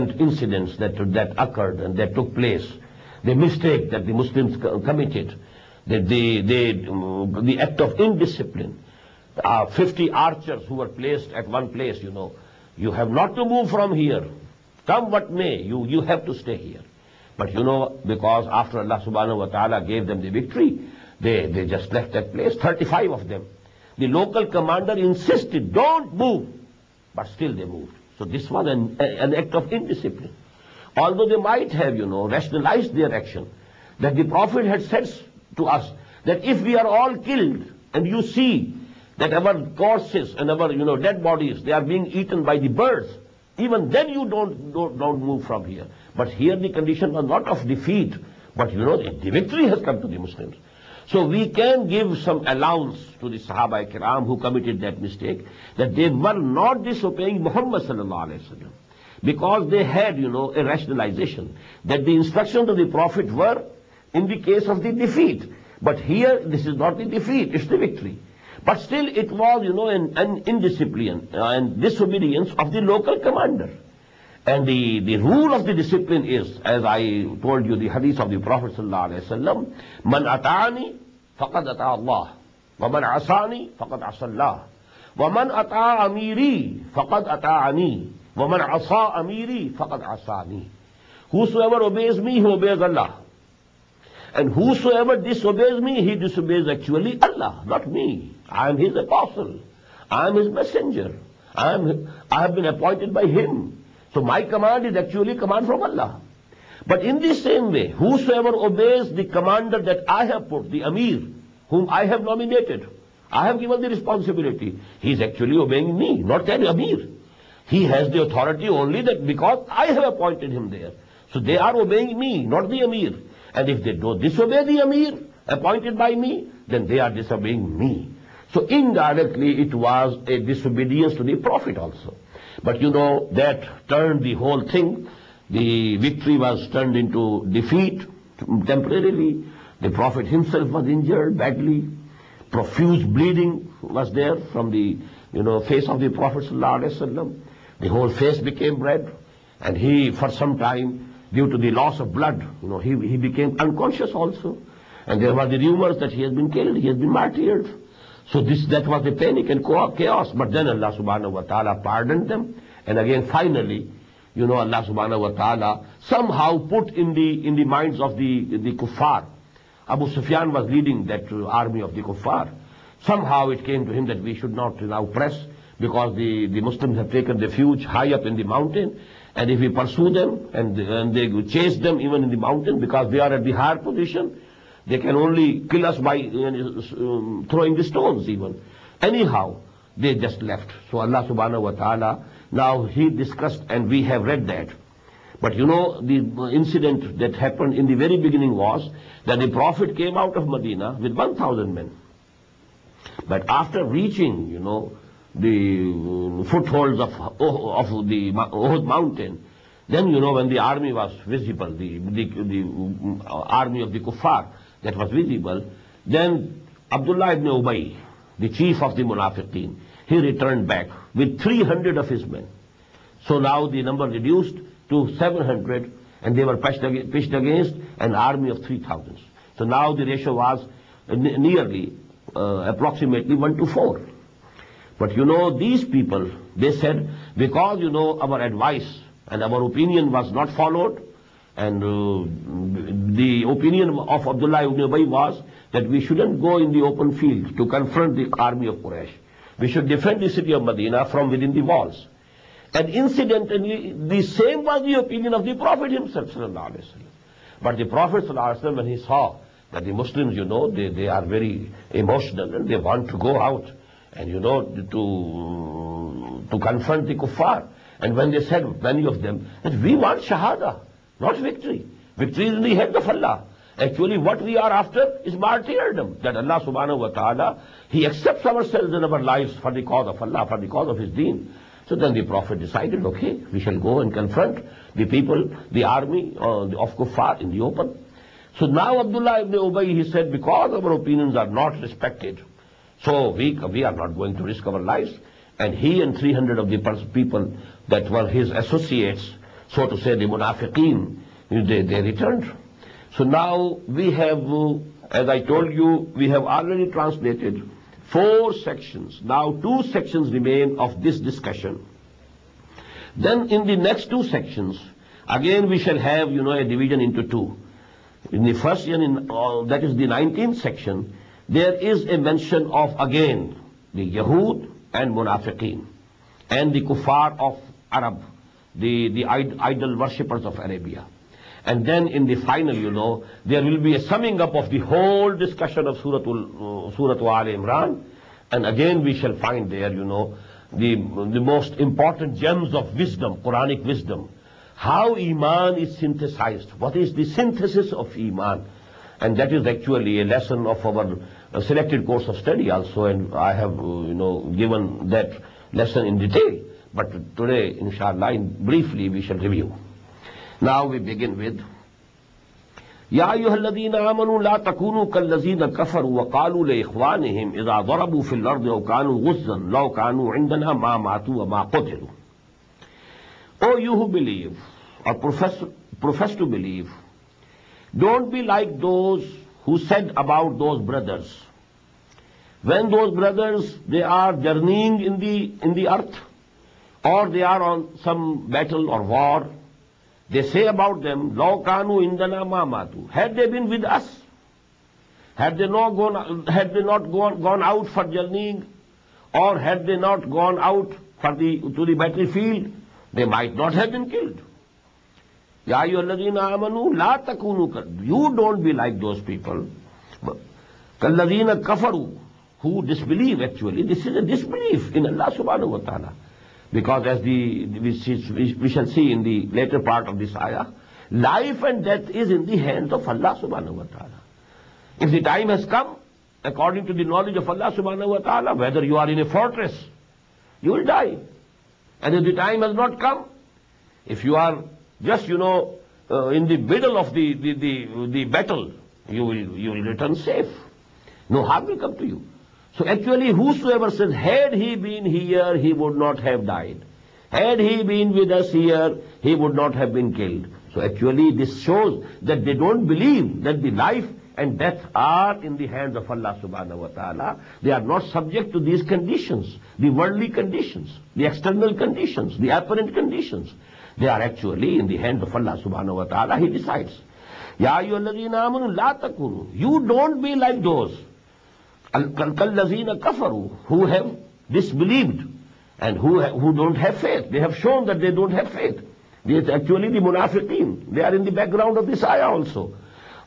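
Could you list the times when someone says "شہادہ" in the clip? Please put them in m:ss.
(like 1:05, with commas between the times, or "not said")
4:30.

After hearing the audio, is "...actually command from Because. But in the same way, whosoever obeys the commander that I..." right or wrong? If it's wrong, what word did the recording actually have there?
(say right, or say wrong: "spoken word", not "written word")
wrong: "Allah", not "Because".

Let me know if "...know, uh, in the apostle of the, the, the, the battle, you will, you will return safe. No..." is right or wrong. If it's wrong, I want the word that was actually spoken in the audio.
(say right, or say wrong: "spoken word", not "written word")
wrong: "middle", not "apostle".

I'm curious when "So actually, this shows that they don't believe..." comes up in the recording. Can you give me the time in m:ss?
7:30.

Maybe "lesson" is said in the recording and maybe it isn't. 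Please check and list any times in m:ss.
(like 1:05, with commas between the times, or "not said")
5:50, 5:55.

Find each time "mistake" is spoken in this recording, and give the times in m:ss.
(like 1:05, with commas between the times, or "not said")
0:03, 0:55.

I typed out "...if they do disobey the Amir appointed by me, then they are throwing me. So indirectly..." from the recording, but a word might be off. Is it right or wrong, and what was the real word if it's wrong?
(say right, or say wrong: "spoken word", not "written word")
wrong: "disobeying", not "throwing".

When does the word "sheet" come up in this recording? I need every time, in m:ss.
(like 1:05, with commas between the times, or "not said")
not said.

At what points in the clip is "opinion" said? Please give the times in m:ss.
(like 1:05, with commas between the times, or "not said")
3:59, 4:50.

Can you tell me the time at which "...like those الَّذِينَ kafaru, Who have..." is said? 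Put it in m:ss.
7:50.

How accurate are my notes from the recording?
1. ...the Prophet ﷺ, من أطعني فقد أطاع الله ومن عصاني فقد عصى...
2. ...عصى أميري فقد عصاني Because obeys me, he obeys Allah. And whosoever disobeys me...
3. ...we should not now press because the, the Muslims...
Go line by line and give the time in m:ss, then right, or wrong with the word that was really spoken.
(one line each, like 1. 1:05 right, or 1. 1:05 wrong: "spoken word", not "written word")
1. 1:18 right
2. 1:28 wrong: "Whosoever", not "Because"
3. 2:54 right.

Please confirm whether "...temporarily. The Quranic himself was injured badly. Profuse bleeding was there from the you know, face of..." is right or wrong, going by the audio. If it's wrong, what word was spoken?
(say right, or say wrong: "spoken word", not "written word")
wrong: "Prophet", not "Quranic".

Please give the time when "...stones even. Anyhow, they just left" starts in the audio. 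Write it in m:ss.
3:07.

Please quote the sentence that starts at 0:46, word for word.
But here the condition was not of defeat, but you know, the victory has come to the Muslims.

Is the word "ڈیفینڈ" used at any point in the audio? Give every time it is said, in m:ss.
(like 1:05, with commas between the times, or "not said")
4:09.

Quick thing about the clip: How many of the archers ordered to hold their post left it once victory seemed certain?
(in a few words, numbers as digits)
35.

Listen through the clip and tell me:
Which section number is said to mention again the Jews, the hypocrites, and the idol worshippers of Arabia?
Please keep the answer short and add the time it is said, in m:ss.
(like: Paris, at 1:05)
19th, at 5:20.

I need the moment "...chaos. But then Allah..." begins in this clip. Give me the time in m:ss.
2:39.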